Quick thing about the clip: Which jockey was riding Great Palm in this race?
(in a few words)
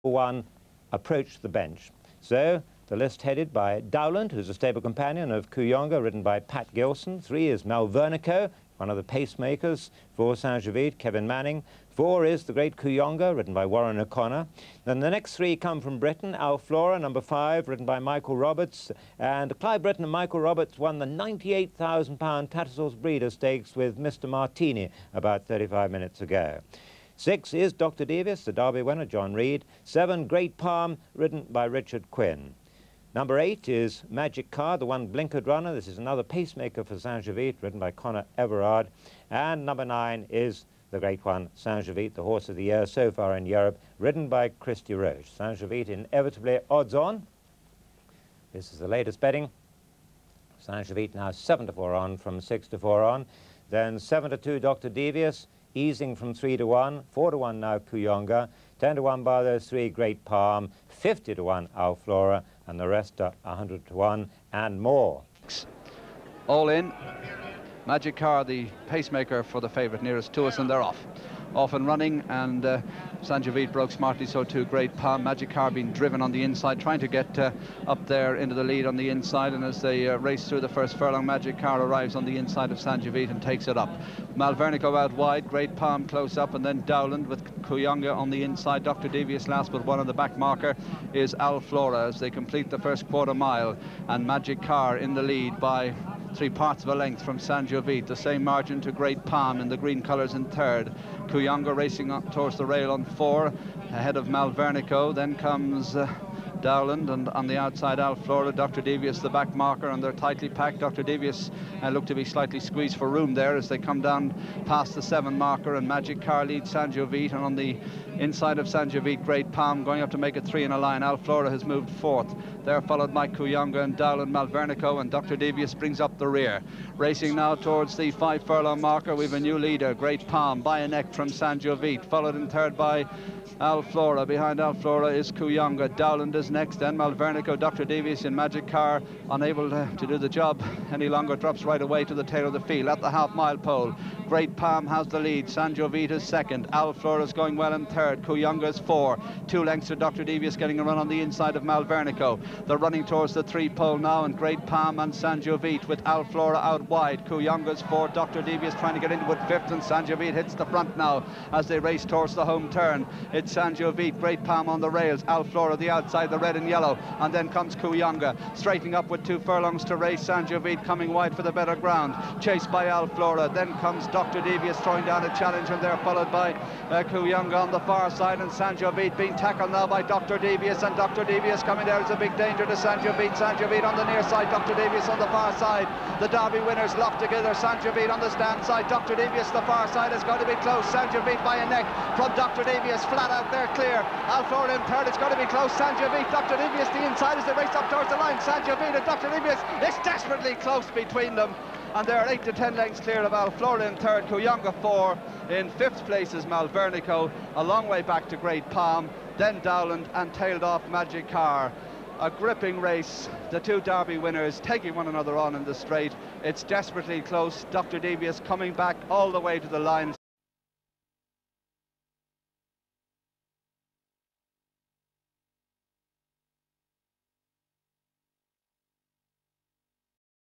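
Richard Quinn.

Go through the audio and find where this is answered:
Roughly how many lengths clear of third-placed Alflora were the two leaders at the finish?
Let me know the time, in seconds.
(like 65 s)
202 s.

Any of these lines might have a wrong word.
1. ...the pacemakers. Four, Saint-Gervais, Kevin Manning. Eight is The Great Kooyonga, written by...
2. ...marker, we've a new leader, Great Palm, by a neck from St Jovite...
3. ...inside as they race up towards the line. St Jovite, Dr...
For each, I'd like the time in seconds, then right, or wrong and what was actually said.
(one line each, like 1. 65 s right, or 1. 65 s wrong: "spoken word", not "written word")
1. 8 s wrong: "Four", not "Eight"
2. 128 s right
3. 197 s right.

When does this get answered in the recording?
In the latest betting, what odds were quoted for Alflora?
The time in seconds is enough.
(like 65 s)
60 s.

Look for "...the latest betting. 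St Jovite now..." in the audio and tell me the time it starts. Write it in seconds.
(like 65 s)
48 s.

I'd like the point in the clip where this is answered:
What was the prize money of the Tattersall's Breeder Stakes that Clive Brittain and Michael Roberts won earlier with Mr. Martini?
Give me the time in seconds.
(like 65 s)
21 s.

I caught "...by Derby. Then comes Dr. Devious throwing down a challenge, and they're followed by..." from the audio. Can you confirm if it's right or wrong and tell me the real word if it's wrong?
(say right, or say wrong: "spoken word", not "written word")
wrong: "Alflora", not "Derby".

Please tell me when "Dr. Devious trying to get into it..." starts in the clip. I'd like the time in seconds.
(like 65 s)
158 s.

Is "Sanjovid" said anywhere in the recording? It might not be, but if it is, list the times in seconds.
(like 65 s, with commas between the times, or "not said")
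183 s.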